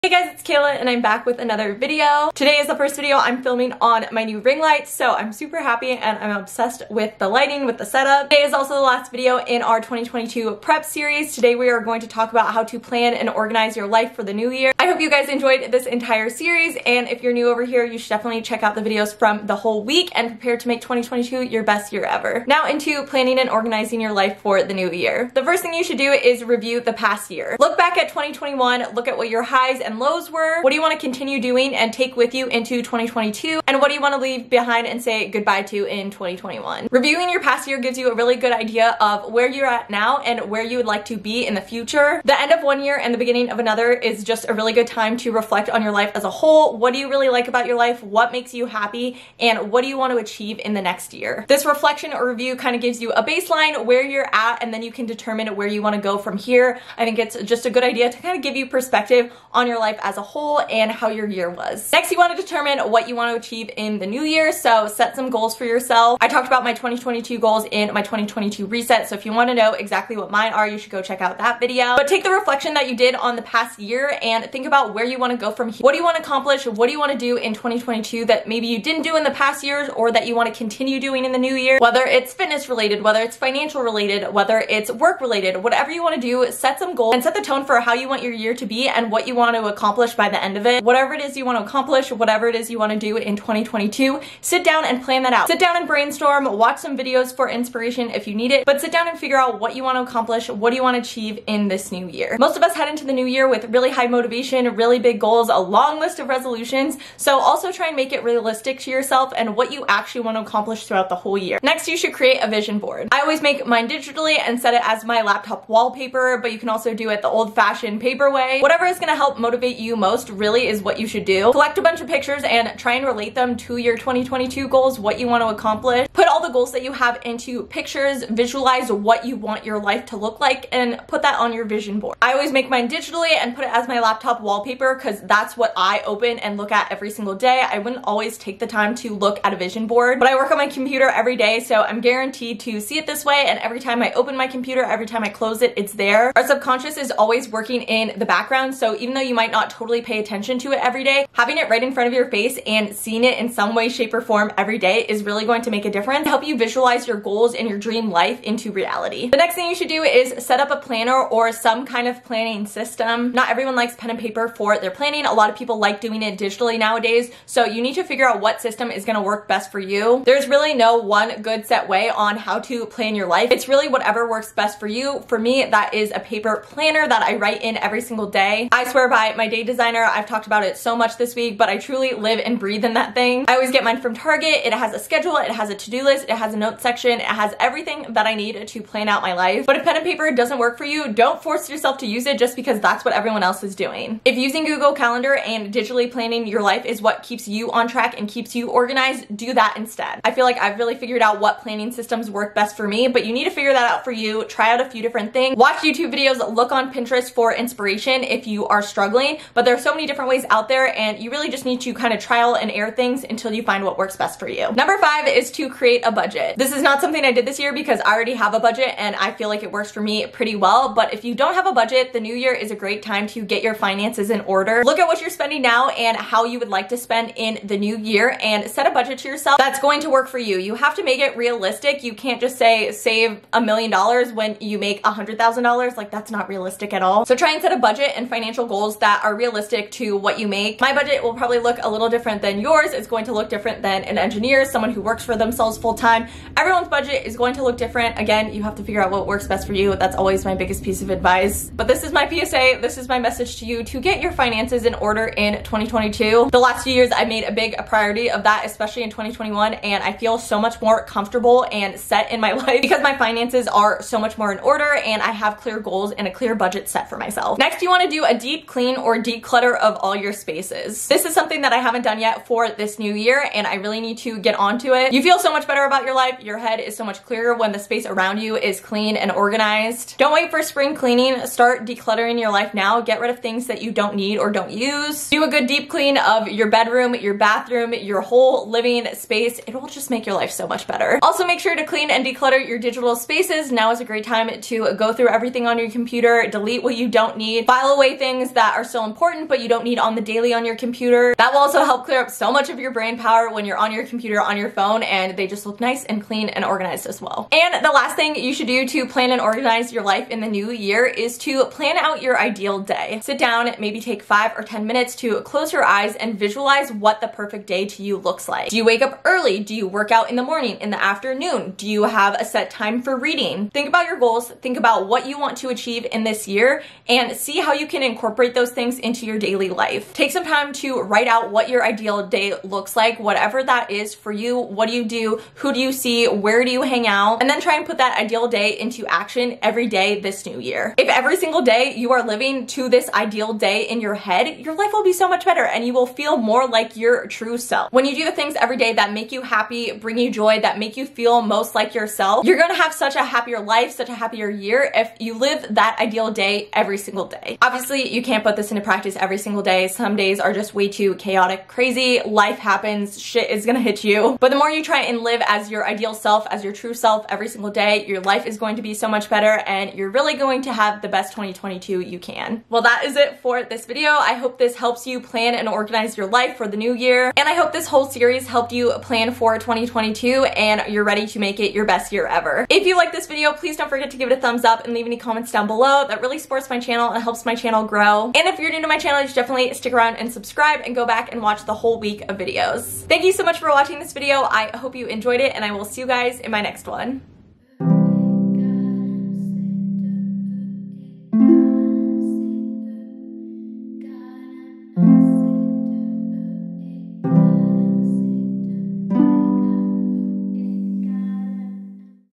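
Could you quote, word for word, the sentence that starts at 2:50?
There's really no one good set way on how to plan your life.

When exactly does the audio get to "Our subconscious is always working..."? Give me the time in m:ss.
2:26.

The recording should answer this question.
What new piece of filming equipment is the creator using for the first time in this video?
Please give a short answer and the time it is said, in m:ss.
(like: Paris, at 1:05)
ring light, at 0:04.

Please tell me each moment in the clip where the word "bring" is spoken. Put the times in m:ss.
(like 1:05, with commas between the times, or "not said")
5:49.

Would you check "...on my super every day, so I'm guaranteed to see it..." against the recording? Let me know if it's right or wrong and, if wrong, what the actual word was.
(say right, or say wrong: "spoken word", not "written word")
wrong: "computer", not "super".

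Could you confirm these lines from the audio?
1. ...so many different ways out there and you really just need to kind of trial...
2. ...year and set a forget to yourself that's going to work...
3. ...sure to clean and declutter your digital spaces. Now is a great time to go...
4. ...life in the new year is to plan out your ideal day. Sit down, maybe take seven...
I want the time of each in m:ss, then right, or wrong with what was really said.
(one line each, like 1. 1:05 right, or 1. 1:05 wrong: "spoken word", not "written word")
1. 3:29 right
2. 3:47 wrong: "budget", not "forget"
3. 4:51 right
4. 5:10 wrong: "five", not "seven".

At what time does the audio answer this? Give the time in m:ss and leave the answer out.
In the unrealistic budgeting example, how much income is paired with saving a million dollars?
3:55.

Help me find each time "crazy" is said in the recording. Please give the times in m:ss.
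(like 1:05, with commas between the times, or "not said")
6:01.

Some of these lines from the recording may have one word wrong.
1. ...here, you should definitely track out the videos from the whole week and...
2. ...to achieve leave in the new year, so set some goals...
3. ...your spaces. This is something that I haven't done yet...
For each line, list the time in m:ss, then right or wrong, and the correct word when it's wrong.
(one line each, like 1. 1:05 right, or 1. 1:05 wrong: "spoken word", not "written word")
1. 0:17 wrong: "check", not "track"
2. 1:03 right
3. 4:30 right.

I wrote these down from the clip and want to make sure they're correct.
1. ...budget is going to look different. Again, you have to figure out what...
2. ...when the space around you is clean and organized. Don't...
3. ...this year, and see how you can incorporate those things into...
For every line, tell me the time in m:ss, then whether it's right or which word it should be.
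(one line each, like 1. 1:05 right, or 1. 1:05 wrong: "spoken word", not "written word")
1. 4:06 right
2. 4:37 right
3. 5:26 right.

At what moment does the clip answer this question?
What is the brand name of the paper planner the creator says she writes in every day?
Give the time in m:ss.
2:59.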